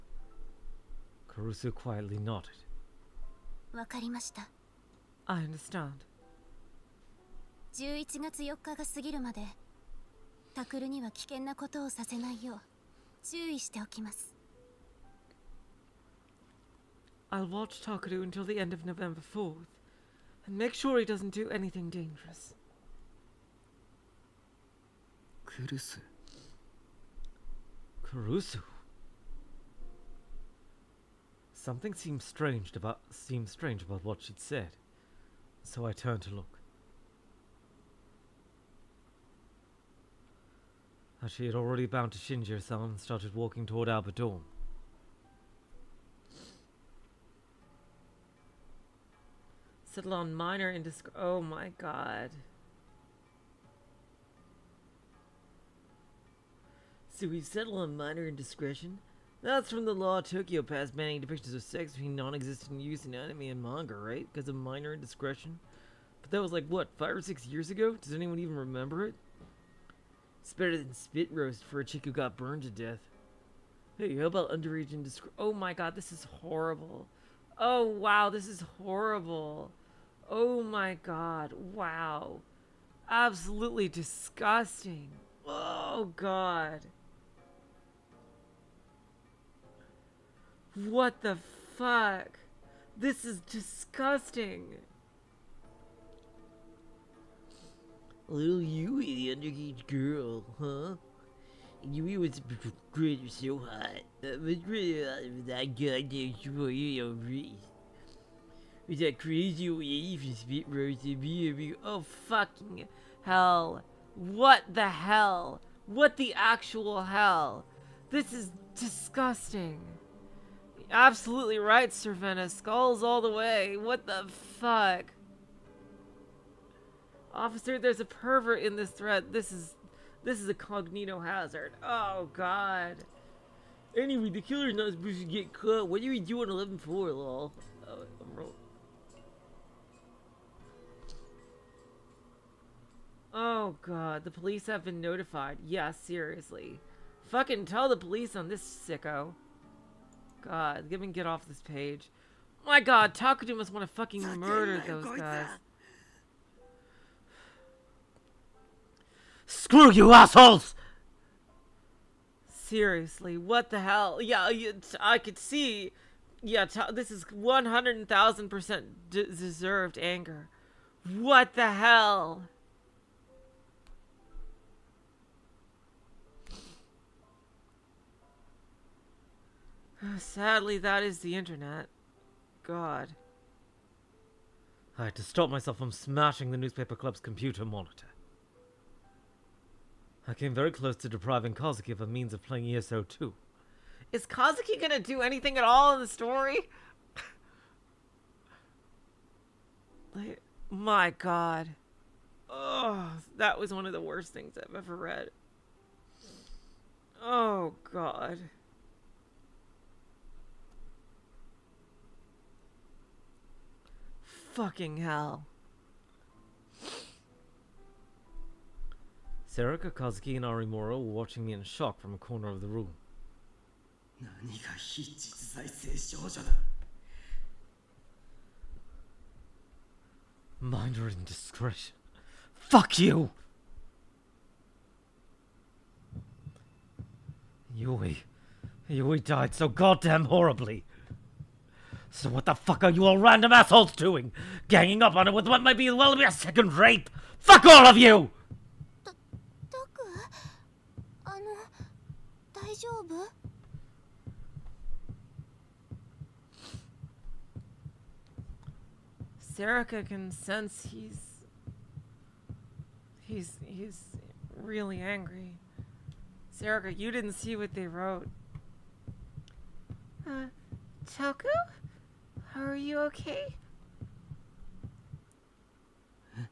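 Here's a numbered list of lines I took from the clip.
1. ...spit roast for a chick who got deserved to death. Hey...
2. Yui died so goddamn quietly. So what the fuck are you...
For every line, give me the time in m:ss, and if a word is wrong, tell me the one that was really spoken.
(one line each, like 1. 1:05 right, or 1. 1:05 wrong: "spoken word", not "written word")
1. 1:10 wrong: "burned", not "deserved"
2. 3:58 wrong: "horribly", not "quietly".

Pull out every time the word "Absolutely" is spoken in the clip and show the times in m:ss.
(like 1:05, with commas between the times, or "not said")
1:23, 2:00.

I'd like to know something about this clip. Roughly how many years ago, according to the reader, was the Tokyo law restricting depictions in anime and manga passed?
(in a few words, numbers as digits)
5 or 6.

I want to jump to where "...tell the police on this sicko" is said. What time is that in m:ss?
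2:27.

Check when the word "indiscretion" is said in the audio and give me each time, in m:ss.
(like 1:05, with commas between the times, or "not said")
0:58, 1:04, 1:14, 3:51.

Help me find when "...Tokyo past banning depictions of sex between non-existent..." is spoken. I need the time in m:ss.
1:00.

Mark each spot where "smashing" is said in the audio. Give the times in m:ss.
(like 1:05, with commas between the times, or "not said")
3:05.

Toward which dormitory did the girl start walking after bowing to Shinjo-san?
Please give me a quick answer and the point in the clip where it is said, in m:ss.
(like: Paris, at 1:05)
Albert Dorm, at 0:43.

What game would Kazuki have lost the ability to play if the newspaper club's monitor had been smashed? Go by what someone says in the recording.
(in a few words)
ESO 2.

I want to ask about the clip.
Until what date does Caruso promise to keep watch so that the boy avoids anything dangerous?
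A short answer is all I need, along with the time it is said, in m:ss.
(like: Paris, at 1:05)
November 4th, at 0:18.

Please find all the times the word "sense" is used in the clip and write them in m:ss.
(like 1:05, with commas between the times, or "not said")
4:20.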